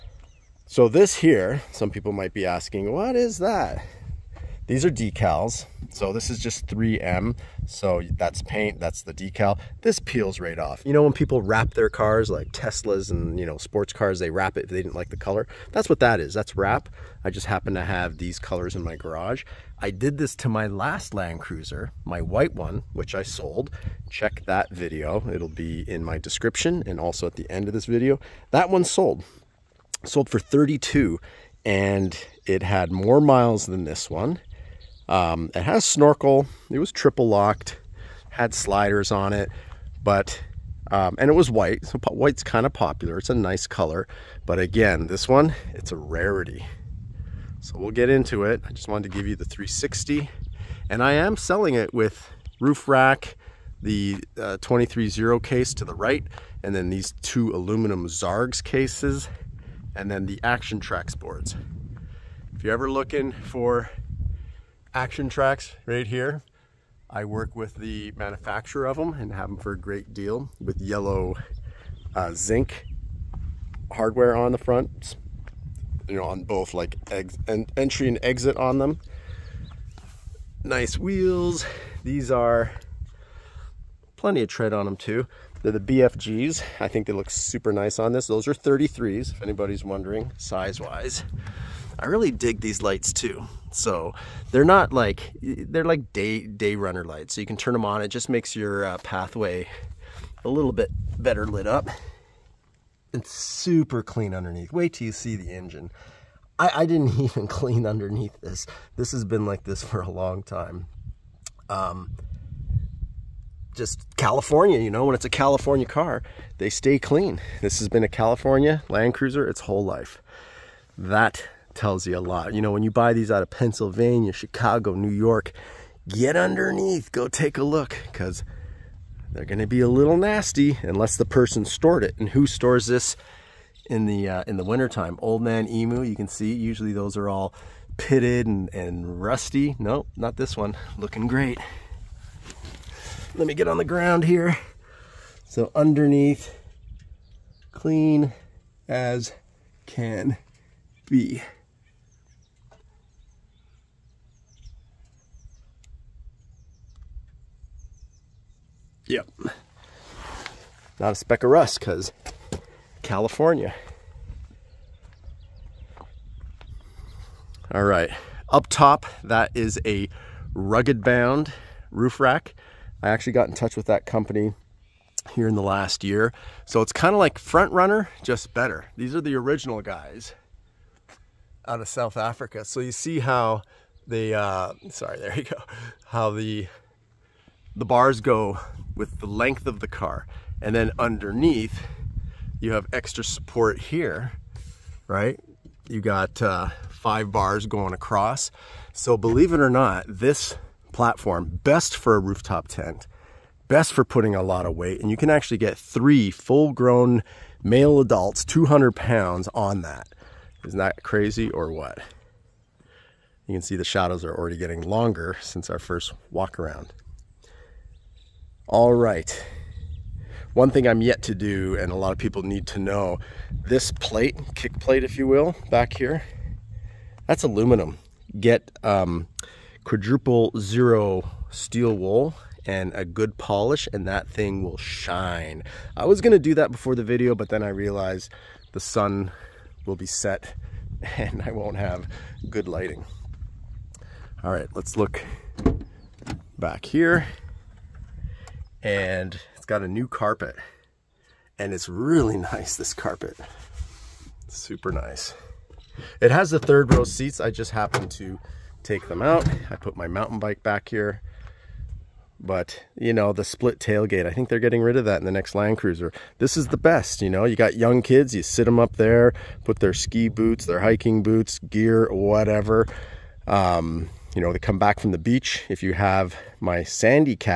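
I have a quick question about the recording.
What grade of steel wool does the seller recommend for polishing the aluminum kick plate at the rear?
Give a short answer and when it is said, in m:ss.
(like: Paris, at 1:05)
Quadruple zero, at 3:49.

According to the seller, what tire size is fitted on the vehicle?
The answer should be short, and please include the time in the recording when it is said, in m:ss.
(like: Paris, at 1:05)
33s, at 1:28.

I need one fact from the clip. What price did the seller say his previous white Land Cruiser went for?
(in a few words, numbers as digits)
32.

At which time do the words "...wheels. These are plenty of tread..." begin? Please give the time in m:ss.
1:20.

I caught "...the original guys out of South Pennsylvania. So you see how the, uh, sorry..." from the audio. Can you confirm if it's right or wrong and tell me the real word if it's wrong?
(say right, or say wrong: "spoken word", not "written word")
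wrong: "Africa", not "Pennsylvania".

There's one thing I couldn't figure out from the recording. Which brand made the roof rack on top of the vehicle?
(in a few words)
Rugged Bound.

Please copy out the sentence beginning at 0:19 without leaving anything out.
I did this to my last Land Cruiser, my white one, which I sold.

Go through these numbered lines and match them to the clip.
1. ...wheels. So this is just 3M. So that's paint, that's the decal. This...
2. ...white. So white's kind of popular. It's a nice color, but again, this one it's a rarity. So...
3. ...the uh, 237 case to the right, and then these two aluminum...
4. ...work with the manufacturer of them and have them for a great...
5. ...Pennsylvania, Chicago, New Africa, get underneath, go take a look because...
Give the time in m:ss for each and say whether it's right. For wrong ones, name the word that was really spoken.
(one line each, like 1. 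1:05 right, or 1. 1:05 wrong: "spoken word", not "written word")
1. 0:04 wrong: "decals", not "wheels"
2. 0:41 right
3. 0:53 wrong: "230", not "237"
4. 1:07 right
5. 2:03 wrong: "York", not "Africa".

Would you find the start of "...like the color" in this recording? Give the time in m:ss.
0:14.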